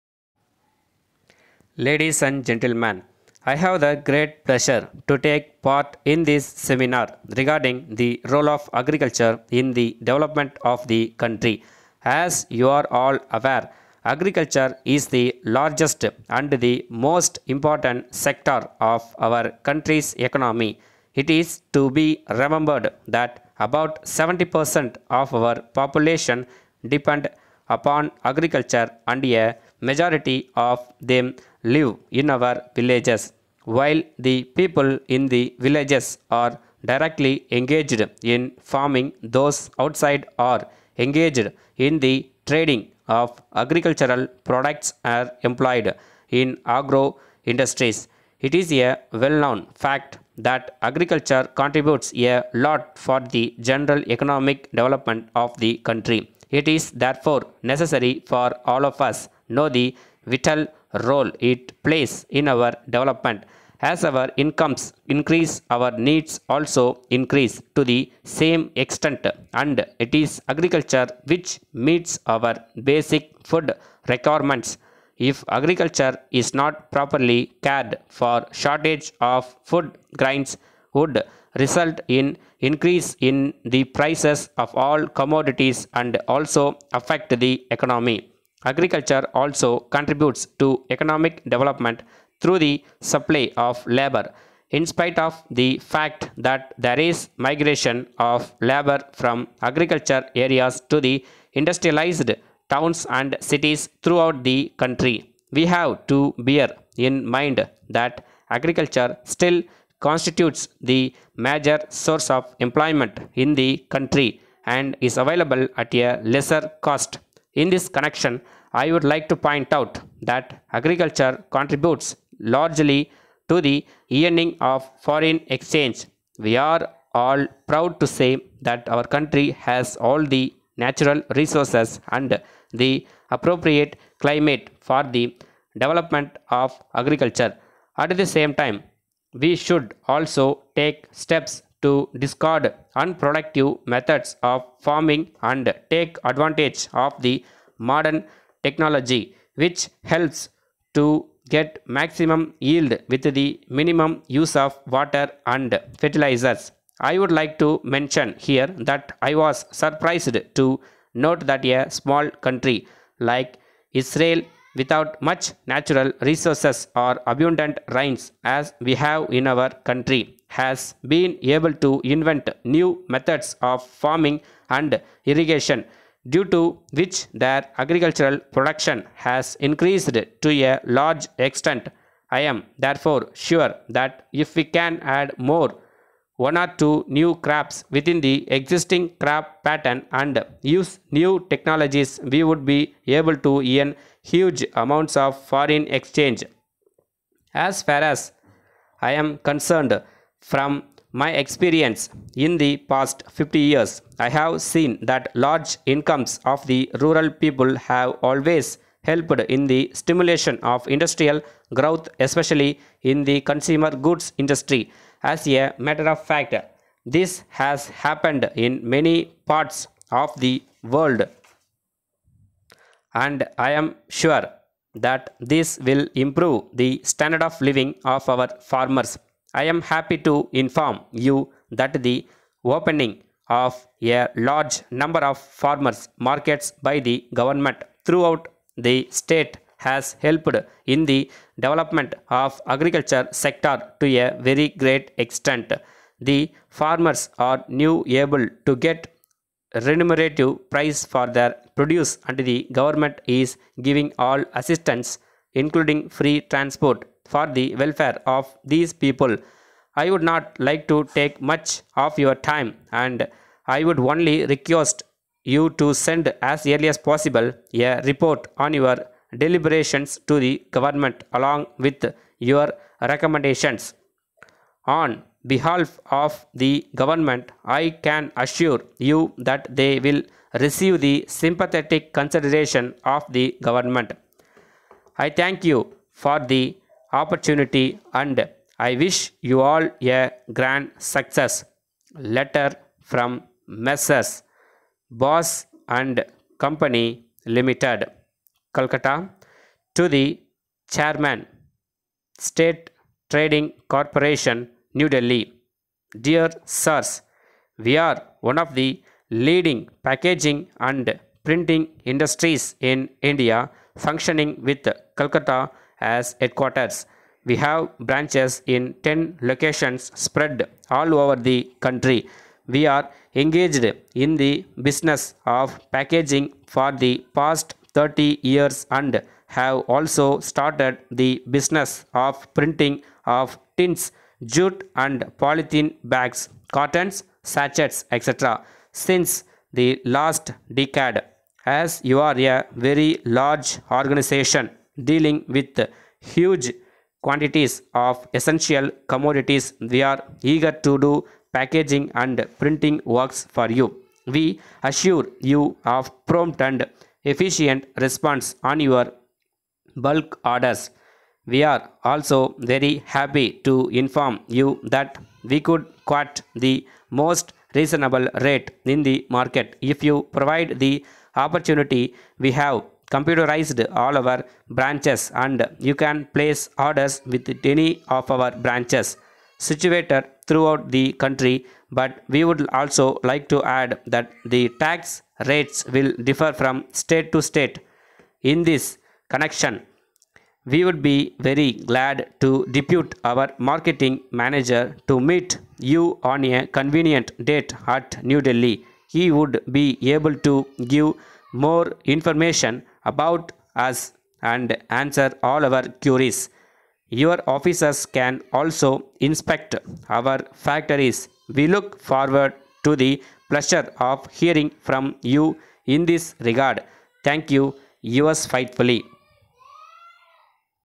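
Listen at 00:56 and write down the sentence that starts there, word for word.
It is therefore necessary for all of us know the vital role it plays in our development.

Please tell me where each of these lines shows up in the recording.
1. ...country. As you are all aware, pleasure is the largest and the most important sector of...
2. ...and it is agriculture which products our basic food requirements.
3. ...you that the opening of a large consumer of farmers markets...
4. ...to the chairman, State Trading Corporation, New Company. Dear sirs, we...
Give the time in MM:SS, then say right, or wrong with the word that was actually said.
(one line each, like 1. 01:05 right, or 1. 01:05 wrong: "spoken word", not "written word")
1. 00:11 wrong: "agriculture", not "pleasure"
2. 01:09 wrong: "meets", not "products"
3. 03:51 wrong: "number", not "consumer"
4. 04:59 wrong: "Delhi", not "Company".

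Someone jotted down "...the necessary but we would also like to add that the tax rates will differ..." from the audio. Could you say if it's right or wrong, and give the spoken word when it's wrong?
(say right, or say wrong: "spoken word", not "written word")
wrong: "country", not "necessary".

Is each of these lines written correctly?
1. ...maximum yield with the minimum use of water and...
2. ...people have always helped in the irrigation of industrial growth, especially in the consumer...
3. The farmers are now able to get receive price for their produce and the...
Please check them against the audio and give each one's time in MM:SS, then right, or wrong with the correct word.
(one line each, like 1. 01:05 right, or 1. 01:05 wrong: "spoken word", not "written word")
1. 02:31 right
2. 03:27 wrong: "stimulation", not "irrigation"
3. 04:06 wrong: "remunerative", not "receive".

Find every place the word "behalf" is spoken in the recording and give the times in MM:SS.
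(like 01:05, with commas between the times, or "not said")
04:35.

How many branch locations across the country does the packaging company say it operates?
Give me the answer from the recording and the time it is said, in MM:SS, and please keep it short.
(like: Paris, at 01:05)
10, at 05:19.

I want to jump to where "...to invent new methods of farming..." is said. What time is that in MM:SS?
02:51.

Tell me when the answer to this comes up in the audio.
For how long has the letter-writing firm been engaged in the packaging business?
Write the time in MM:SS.
05:27.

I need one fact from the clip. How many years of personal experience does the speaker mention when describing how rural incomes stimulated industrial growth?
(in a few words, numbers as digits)
50.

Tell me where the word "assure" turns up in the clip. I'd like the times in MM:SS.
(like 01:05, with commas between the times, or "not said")
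04:38, 05:54.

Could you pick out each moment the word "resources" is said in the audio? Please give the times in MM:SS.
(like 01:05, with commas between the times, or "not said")
02:11, 02:46.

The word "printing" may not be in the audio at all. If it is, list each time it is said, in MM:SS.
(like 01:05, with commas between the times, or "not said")
05:11, 05:32, 05:52.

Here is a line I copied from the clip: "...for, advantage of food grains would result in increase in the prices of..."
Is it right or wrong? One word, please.
wrong.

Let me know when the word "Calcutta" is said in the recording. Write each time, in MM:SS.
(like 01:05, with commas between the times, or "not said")
04:58, 05:15.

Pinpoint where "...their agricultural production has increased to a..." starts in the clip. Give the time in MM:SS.
02:57.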